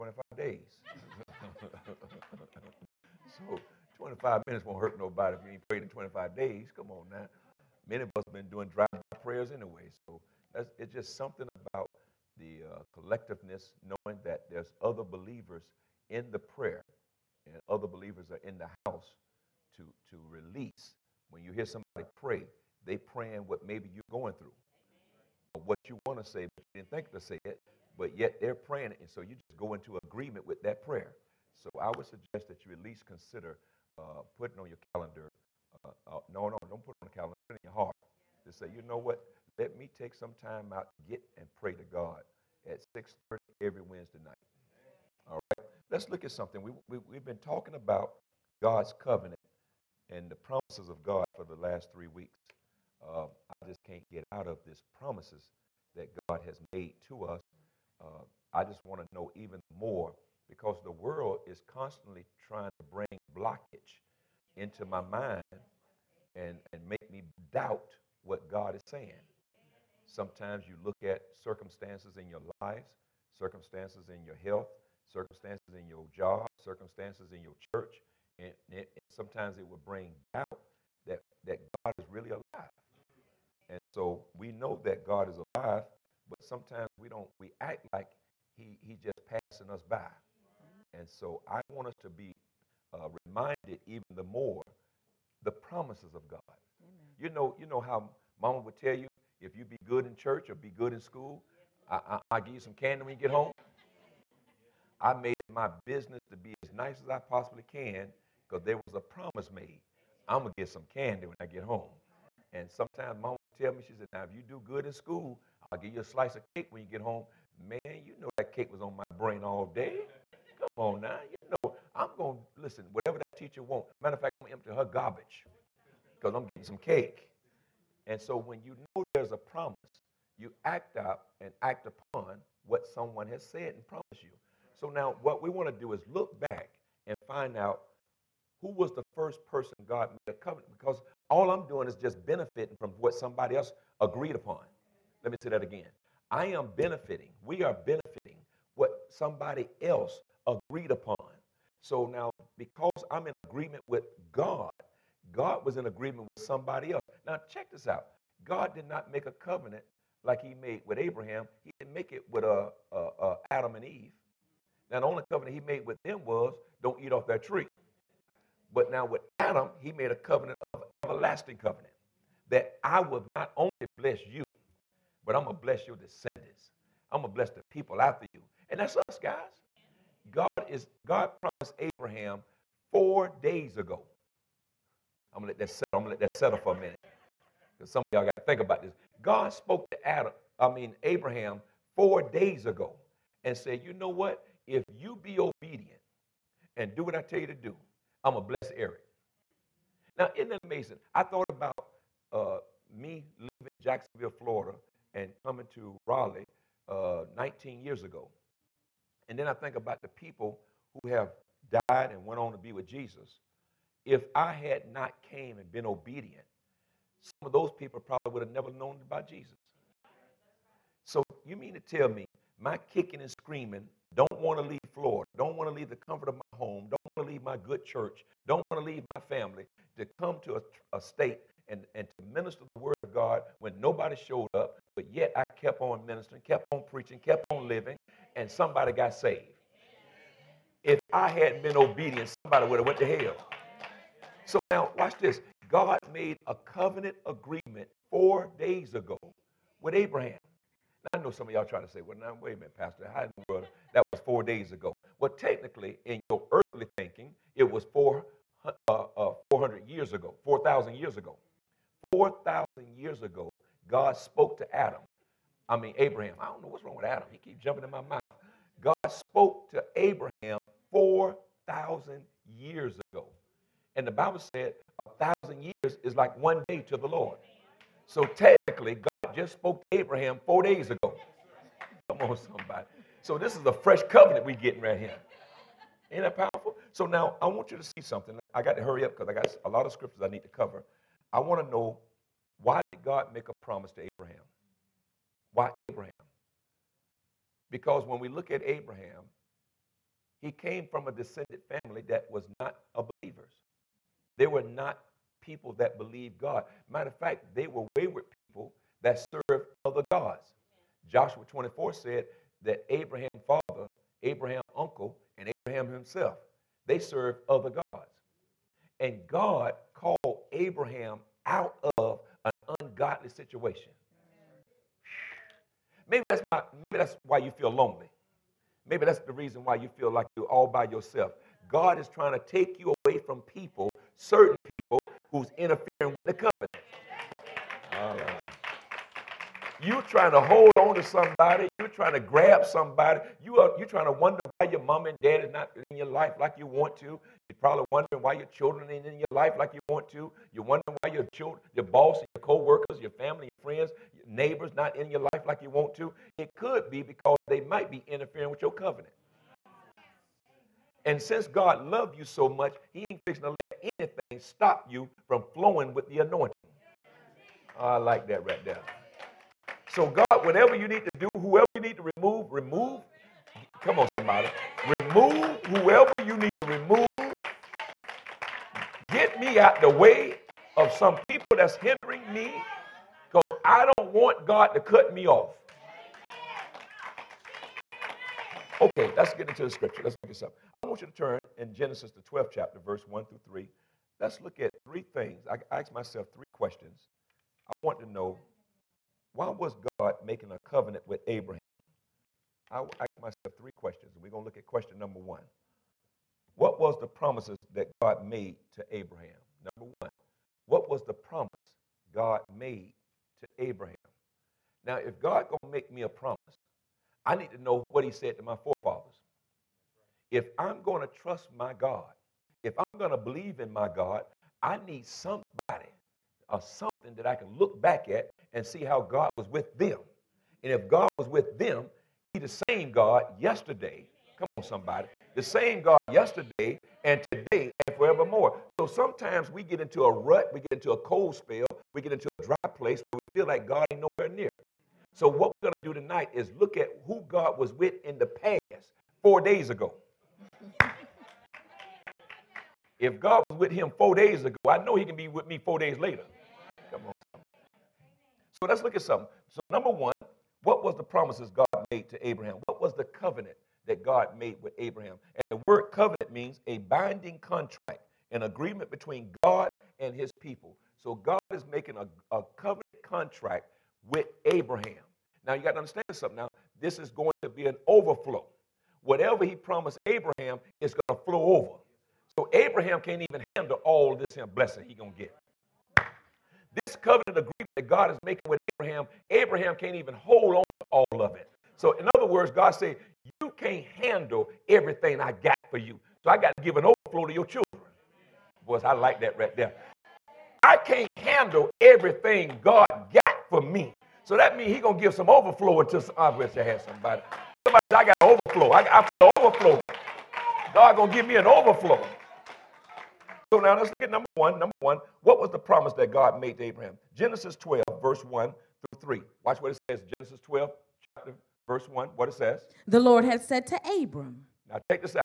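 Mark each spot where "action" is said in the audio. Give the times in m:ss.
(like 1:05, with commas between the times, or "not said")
not said.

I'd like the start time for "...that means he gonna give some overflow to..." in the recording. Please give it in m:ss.
8:24.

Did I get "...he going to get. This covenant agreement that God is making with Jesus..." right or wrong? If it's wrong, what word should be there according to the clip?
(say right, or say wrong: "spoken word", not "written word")
wrong: "Abraham", not "Jesus".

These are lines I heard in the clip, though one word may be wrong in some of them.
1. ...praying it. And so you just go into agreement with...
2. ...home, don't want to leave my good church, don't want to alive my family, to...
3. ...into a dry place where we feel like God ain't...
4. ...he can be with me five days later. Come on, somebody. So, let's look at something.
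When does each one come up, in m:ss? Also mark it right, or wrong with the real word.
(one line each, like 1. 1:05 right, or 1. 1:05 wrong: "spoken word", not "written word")
1. 0:28 right
2. 3:46 wrong: "leave", not "alive"
3. 7:22 right
4. 7:34 wrong: "four", not "five".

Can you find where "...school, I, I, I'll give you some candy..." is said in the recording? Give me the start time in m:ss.
1:41.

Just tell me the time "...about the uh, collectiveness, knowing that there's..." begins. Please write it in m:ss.
0:11.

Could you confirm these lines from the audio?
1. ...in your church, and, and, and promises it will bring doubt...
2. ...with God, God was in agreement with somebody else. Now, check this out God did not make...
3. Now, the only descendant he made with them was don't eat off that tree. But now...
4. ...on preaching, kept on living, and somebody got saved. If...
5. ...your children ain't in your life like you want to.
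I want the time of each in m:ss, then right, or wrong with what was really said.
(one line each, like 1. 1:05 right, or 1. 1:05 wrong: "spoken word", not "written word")
1. 1:17 wrong: "sometimes", not "promises"
2. 2:33 right
3. 2:44 wrong: "covenant", not "descendant"
4. 3:56 right
5. 5:48 right.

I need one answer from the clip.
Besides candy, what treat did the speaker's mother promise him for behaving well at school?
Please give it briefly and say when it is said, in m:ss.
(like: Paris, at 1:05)
a slice of cake, at 1:56.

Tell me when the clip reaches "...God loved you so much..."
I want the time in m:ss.
6:01.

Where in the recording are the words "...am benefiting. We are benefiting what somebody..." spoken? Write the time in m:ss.
2:26.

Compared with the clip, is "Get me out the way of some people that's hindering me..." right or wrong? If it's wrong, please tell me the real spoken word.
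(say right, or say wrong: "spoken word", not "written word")
right.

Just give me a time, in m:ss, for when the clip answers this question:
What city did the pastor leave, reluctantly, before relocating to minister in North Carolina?
3:23.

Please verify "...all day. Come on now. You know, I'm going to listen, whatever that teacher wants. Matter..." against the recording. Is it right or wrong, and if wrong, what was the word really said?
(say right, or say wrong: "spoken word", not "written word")
right.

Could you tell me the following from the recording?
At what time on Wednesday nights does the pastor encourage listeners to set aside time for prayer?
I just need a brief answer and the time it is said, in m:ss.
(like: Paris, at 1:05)
6:30, at 0:42.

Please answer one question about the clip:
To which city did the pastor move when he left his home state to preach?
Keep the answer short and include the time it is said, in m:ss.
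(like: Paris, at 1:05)
Raleigh, at 3:26.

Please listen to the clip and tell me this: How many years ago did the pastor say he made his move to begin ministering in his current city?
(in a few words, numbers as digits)
19.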